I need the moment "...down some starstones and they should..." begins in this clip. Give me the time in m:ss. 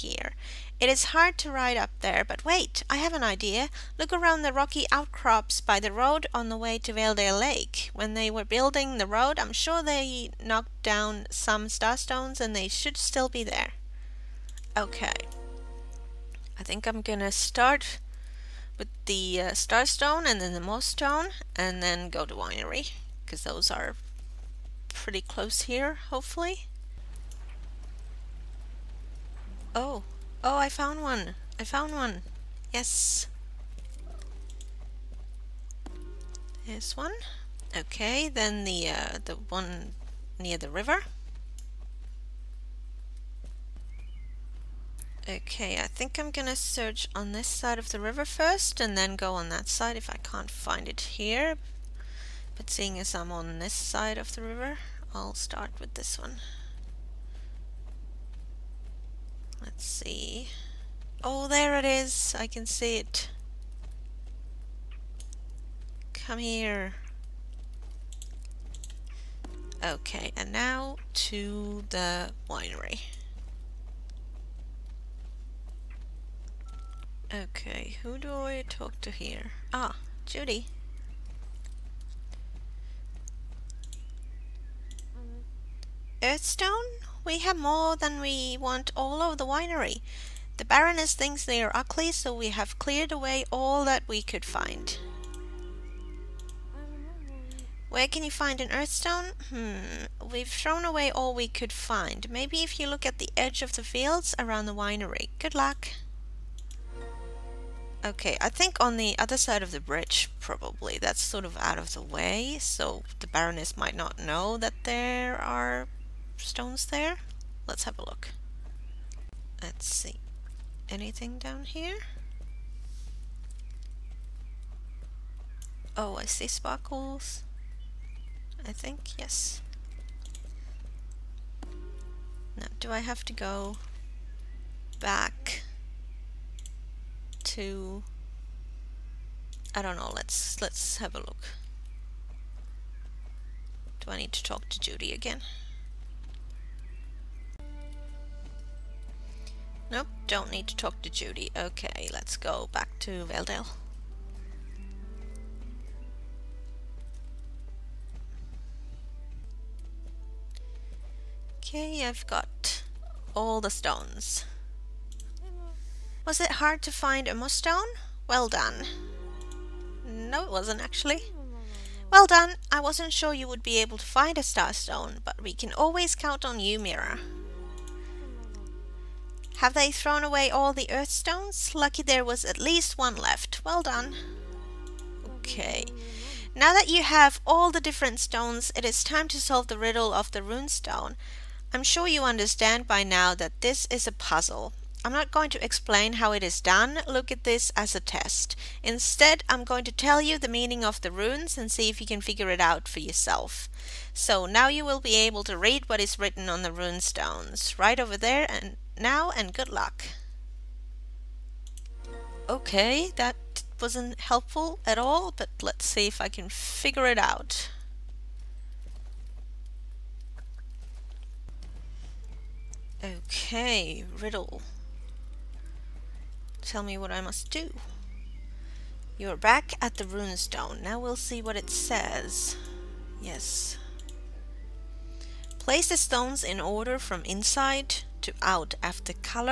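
0:10.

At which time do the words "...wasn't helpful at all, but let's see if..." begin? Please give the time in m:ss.
3:33.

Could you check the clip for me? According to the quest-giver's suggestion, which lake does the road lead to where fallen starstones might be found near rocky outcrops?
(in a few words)
Valedale Lake.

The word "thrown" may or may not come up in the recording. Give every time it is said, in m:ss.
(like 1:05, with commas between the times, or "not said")
1:40, 2:59.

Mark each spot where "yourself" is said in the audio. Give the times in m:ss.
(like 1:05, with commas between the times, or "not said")
3:22.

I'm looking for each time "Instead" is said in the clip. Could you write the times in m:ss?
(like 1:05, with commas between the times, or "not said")
3:18.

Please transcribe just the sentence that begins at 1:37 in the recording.
Where can you find an earthstone?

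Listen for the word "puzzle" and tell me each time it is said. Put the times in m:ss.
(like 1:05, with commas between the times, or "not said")
3:14.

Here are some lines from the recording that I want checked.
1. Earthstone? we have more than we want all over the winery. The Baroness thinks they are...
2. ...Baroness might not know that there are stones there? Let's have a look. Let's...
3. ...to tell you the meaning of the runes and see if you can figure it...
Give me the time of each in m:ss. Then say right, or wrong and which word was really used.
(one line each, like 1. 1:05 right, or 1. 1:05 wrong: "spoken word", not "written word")
1. 1:26 right
2. 1:53 right
3. 3:19 right.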